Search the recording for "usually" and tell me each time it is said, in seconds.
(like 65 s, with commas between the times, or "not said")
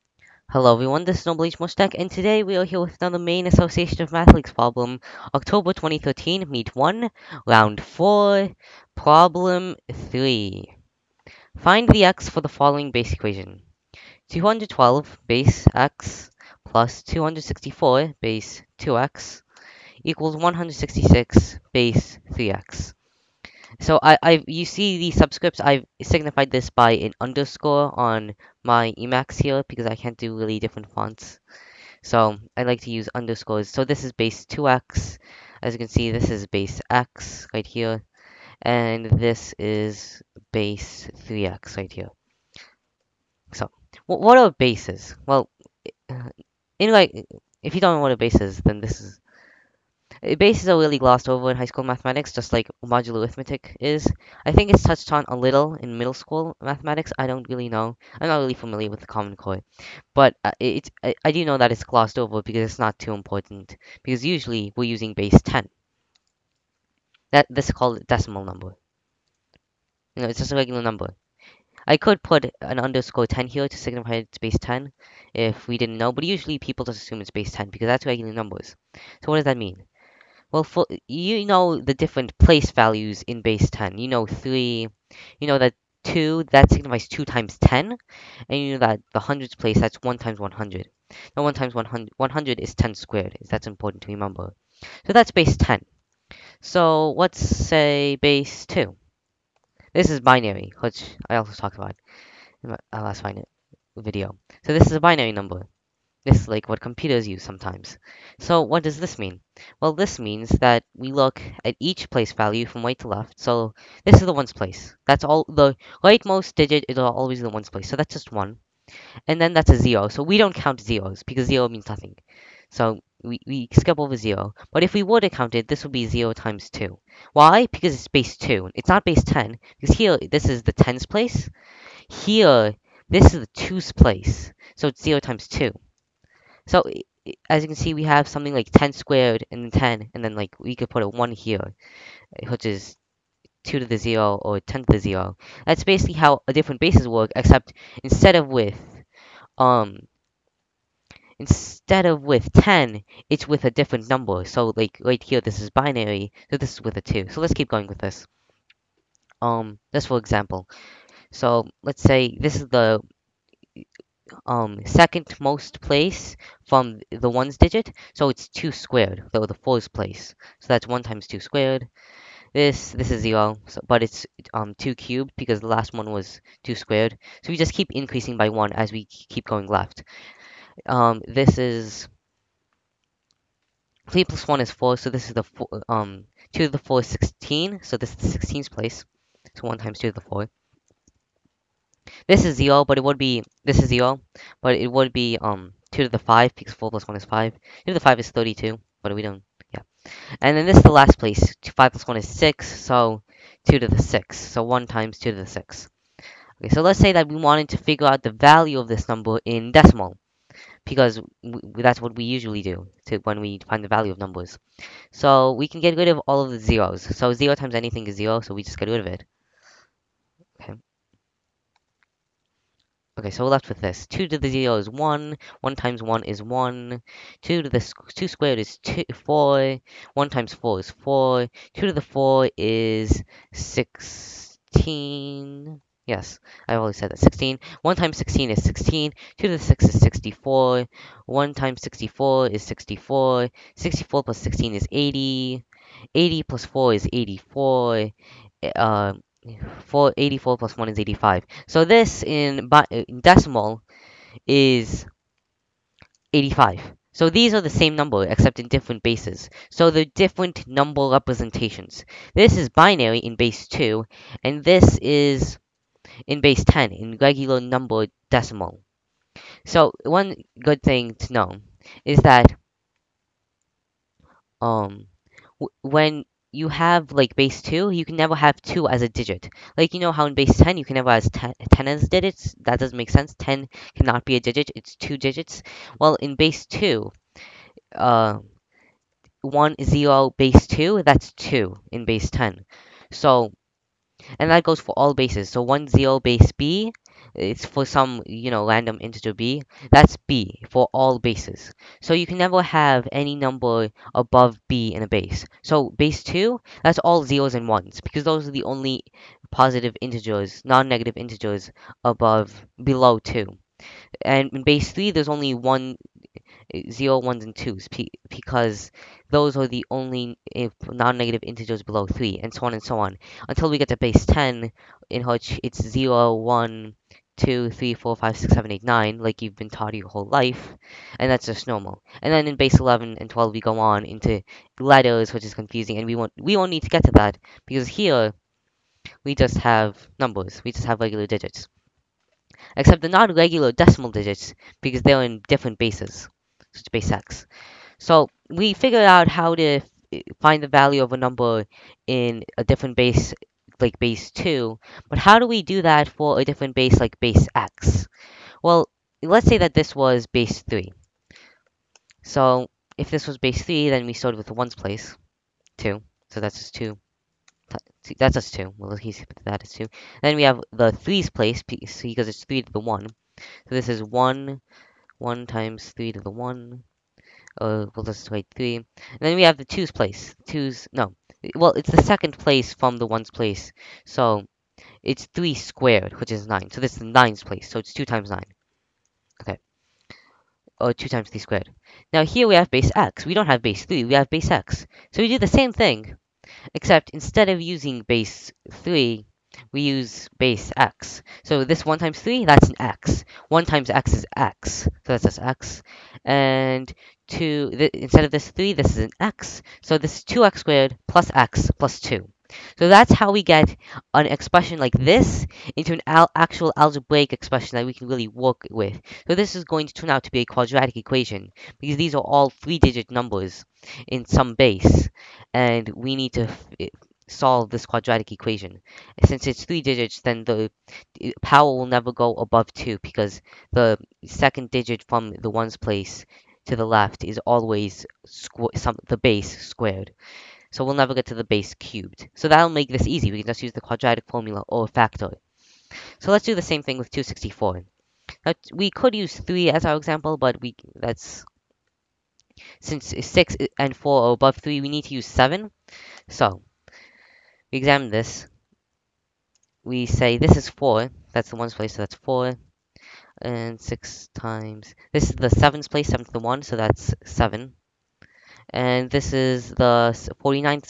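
64 s, 76 s, 212 s.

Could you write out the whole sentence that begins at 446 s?
So let's do the same thing with 264.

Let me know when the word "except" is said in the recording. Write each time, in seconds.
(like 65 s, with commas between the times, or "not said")
147 s, 258 s, 342 s, 396 s.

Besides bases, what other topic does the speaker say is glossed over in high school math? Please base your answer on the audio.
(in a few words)
modular arithmetic.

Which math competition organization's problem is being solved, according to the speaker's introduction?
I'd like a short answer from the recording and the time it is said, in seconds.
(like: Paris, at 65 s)
Maine Association of Mathematics, at 3 s.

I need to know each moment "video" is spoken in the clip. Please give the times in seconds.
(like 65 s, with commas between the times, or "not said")
103 s.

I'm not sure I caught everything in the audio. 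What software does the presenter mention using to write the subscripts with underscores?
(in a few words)
Emacs.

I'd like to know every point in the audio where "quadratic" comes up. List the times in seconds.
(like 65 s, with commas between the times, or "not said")
420 s, 427 s, 443 s.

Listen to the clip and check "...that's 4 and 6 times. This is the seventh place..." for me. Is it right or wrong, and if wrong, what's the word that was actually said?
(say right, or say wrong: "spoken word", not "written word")
right.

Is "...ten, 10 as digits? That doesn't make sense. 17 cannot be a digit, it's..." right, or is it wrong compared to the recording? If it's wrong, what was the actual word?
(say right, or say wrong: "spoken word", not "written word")
wrong: "10", not "17".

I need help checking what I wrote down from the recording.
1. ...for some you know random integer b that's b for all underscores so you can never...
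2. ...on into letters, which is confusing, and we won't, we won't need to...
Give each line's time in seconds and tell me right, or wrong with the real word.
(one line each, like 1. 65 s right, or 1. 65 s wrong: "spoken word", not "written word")
1. 297 s wrong: "bases", not "underscores"
2. 333 s right.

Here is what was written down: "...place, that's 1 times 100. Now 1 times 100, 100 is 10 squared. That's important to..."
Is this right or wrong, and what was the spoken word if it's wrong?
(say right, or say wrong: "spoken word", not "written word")
right.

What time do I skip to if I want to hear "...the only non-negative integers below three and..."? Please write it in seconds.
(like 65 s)
319 s.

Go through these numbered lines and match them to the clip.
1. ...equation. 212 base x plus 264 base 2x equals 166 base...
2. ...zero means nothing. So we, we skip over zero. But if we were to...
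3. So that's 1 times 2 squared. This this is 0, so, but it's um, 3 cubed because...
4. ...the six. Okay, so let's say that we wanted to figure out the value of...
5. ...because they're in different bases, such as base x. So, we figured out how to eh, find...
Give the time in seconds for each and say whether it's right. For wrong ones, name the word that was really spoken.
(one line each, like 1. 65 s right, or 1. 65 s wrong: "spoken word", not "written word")
1. 13 s right
2. 121 s right
3. 170 s wrong: "2", not "3"
4. 205 s right
5. 344 s right.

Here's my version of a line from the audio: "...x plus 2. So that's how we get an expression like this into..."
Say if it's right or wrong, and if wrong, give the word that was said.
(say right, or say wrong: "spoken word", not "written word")
right.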